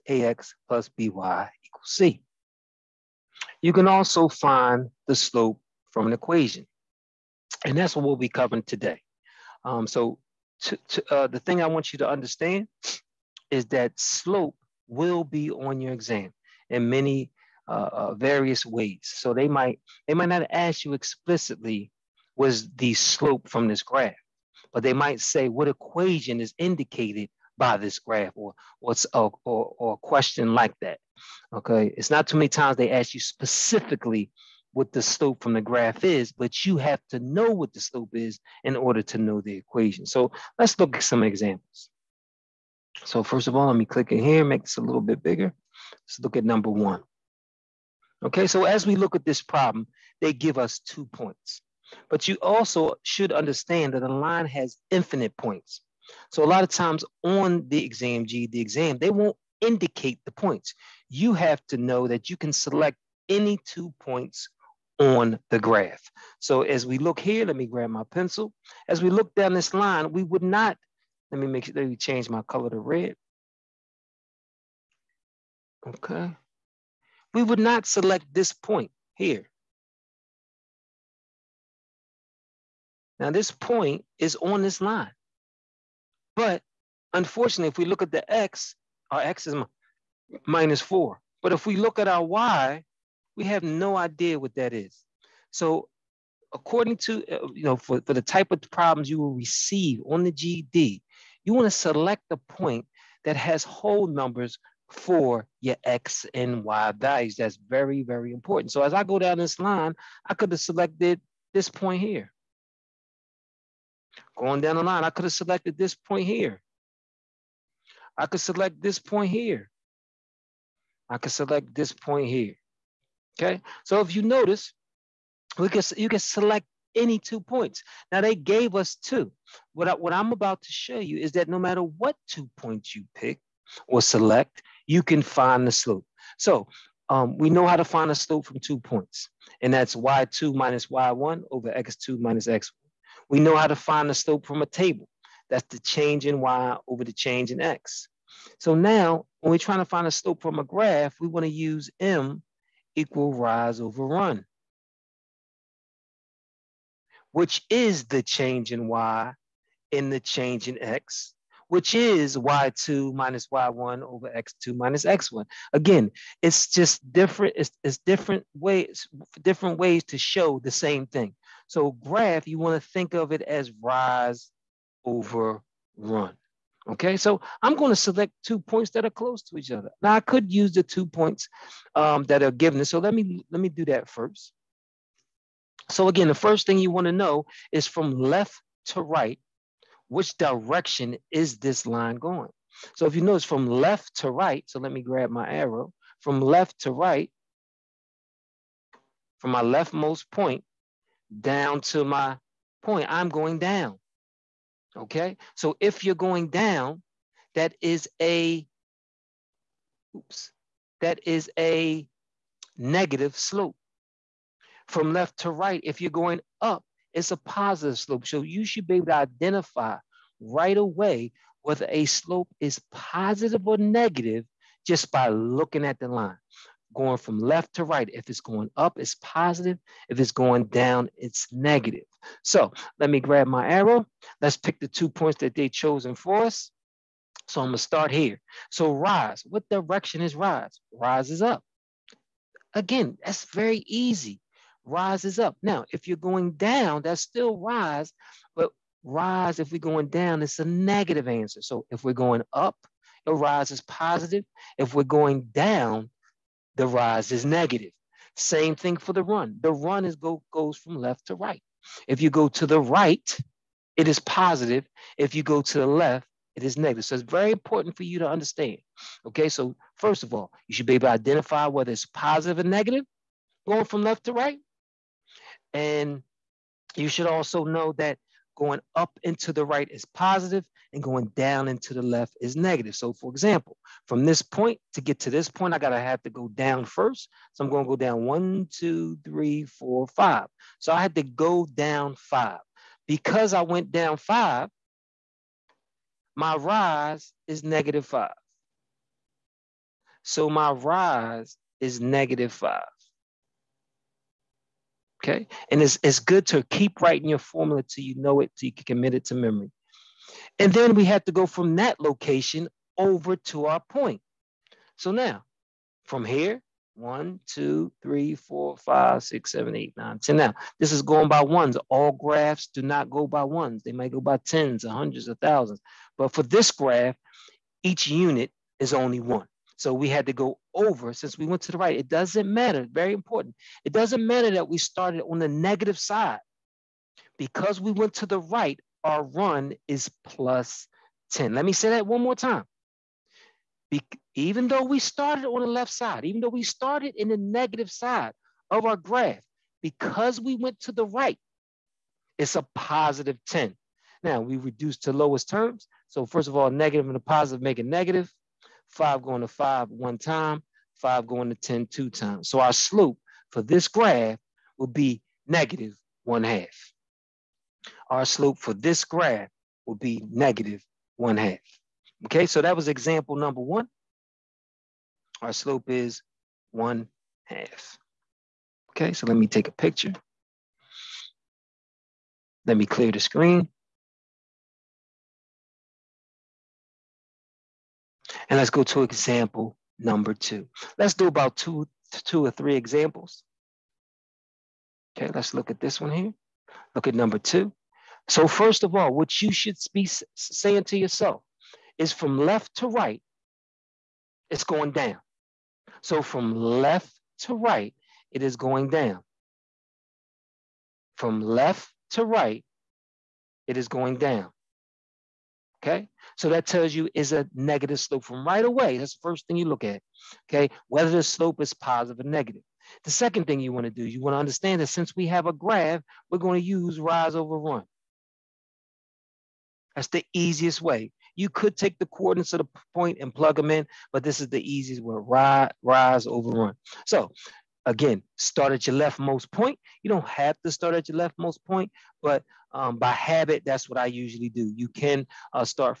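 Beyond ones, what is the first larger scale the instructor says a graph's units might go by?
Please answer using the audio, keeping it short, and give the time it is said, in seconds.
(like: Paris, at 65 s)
tens, at 324 s.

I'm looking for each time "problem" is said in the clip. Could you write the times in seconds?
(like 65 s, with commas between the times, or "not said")
49 s, 98 s.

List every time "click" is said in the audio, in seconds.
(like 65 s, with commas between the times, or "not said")
43 s.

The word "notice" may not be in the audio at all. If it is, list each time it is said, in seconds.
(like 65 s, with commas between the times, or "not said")
124 s, 193 s.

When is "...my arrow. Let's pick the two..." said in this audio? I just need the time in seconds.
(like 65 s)
233 s.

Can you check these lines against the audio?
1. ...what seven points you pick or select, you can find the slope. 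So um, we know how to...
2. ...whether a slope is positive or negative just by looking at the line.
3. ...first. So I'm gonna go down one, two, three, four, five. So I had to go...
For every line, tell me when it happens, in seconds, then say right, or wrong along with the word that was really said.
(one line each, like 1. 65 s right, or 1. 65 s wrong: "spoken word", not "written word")
1. 131 s wrong: "two", not "seven"
2. 221 s right
3. 286 s right.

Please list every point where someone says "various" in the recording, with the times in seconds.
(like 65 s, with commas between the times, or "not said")
18 s.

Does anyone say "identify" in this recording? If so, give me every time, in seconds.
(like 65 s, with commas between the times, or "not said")
219 s, 271 s.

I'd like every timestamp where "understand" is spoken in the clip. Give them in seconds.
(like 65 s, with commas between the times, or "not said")
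12 s, 53 s, 268 s, 424 s.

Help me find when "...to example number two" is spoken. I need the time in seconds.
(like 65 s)
388 s.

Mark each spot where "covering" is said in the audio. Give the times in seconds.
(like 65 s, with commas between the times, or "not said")
8 s.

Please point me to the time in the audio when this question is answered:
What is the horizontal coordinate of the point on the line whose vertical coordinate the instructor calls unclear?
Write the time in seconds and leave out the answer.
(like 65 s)
90 s.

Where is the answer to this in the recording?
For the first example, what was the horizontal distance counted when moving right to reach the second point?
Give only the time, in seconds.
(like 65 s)
340 s.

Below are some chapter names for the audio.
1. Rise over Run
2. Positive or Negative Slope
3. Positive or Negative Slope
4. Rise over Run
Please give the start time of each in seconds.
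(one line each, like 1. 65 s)
1. 430 s
2. 192 s
3. 403 s
4. 234 s.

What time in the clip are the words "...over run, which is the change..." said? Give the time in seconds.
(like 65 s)
153 s.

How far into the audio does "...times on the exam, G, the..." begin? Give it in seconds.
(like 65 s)
56 s.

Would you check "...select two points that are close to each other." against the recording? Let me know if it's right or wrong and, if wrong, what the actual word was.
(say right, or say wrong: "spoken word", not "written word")
right.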